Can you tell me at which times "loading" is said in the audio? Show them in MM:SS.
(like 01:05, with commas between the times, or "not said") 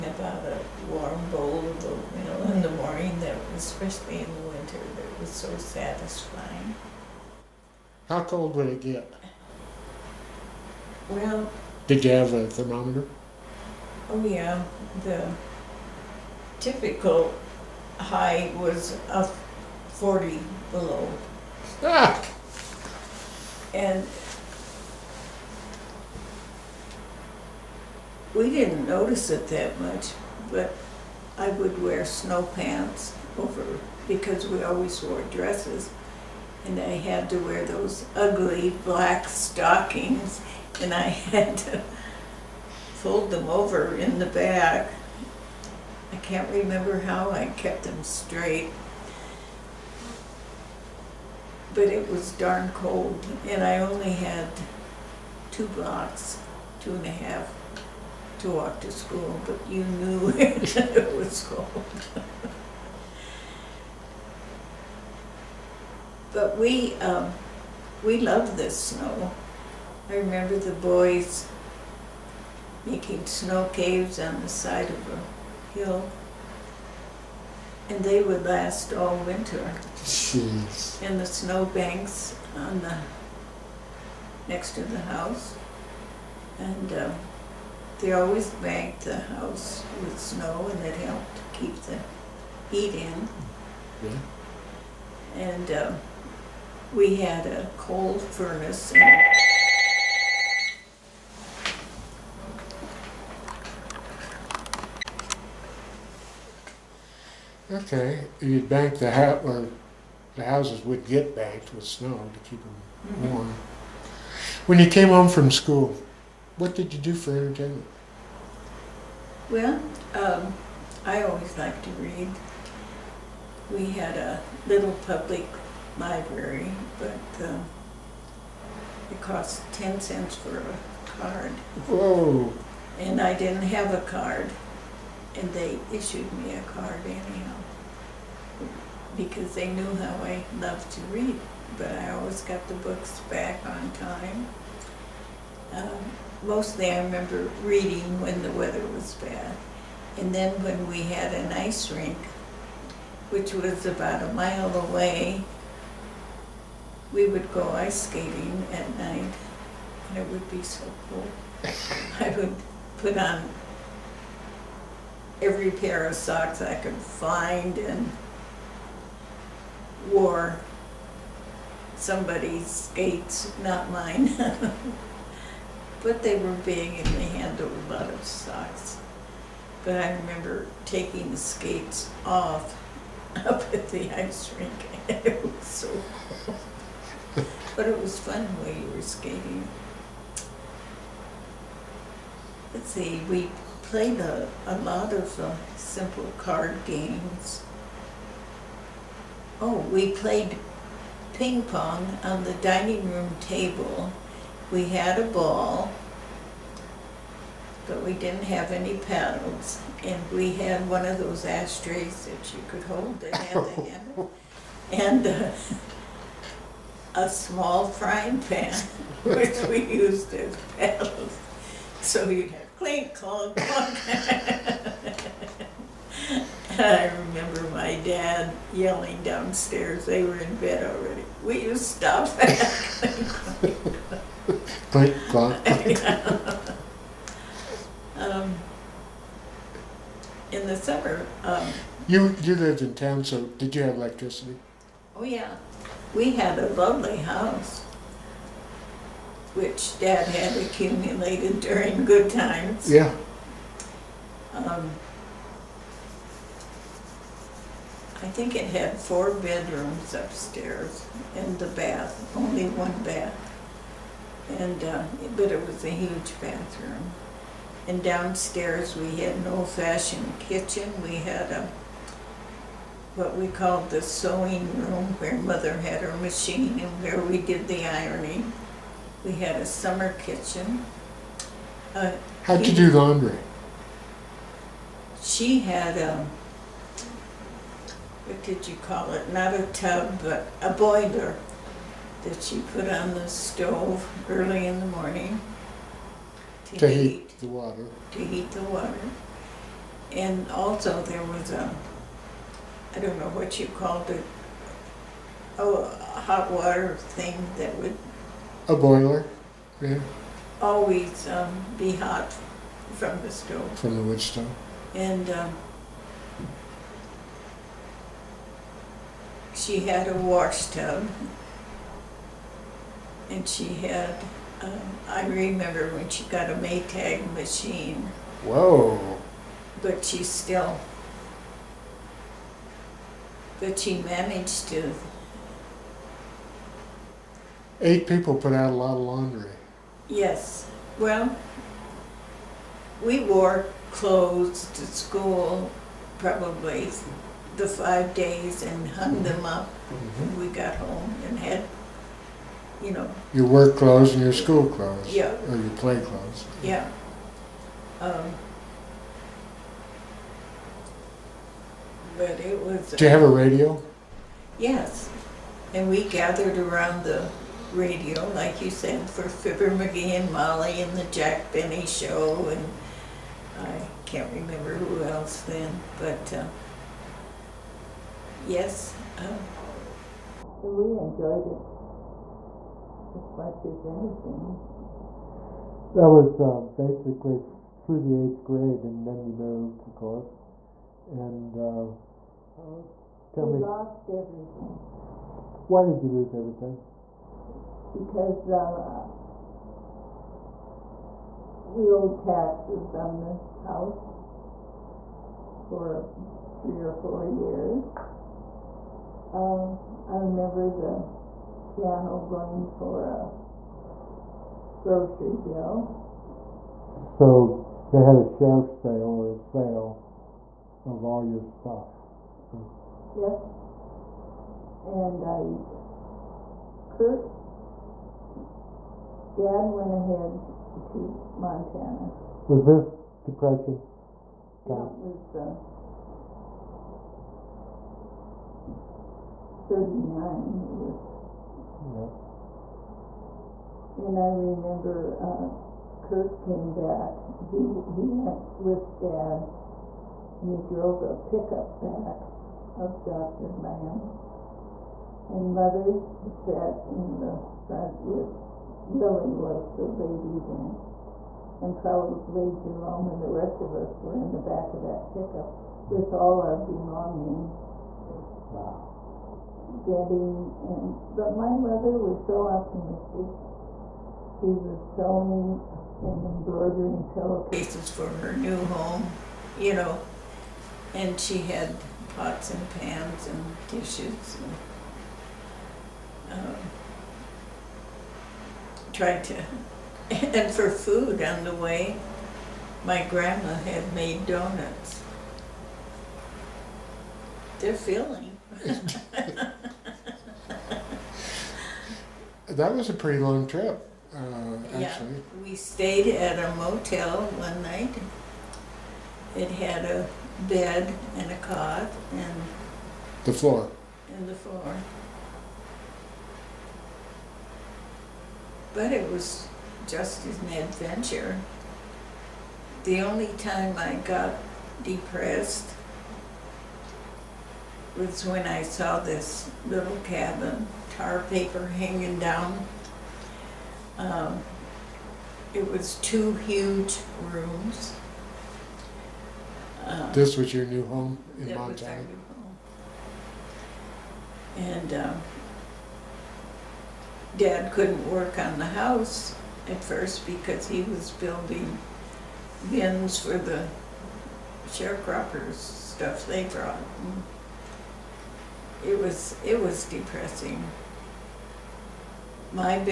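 not said.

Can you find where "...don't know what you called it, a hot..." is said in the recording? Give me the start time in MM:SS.
05:02.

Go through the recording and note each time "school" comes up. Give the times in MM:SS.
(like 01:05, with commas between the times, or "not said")
00:58, 01:55, 05:44, 05:54.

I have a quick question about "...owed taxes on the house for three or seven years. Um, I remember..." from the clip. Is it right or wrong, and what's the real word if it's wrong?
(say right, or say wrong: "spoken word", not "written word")
wrong: "four", not "seven".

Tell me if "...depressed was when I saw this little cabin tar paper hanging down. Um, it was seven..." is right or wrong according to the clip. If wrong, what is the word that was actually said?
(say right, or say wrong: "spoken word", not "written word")
wrong: "two", not "seven".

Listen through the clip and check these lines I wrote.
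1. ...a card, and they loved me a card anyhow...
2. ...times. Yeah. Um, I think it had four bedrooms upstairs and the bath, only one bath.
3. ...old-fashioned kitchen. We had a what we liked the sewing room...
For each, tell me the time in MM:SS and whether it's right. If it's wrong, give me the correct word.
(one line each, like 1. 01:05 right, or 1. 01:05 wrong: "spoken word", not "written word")
1. 02:13 wrong: "issued", not "loved"
2. 04:12 right
3. 04:29 wrong: "called", not "liked".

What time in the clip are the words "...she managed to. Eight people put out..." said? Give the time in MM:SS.
05:33.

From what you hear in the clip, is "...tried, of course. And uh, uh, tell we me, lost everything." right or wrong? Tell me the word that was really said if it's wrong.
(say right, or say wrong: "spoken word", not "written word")
wrong: "moved", not "tried".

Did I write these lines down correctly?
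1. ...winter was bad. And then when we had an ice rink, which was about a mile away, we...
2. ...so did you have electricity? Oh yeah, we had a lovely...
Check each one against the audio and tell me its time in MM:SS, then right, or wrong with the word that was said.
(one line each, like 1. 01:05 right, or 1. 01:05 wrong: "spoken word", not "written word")
1. 02:28 wrong: "weather", not "winter"
2. 04:03 right.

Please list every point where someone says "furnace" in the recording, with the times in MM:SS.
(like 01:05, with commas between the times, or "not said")
01:38.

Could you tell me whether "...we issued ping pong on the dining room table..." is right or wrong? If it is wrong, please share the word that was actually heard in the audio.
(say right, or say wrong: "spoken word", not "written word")
wrong: "played", not "issued".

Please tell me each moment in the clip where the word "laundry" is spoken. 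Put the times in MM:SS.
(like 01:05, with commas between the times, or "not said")
04:42, 05:39.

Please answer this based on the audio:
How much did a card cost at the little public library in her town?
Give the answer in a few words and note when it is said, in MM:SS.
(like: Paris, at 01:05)
10 cents, at 02:09.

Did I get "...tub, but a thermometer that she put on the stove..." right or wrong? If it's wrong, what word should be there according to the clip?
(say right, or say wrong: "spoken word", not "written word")
wrong: "boiler", not "thermometer".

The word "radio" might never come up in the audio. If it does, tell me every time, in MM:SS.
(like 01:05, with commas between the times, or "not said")
06:03, 06:07.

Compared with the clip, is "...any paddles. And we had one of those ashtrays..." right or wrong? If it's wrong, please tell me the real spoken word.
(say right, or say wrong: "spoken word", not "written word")
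right.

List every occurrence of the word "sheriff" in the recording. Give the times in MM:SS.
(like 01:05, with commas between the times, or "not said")
06:58.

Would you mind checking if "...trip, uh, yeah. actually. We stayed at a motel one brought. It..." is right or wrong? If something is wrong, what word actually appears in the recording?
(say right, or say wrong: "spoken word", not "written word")
wrong: "night", not "brought".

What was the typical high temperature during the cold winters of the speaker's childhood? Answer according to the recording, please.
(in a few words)
40 below.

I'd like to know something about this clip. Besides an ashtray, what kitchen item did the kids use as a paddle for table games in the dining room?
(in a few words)
small frying pan.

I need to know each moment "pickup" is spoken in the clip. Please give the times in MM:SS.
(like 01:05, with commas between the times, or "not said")
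07:31, 07:45.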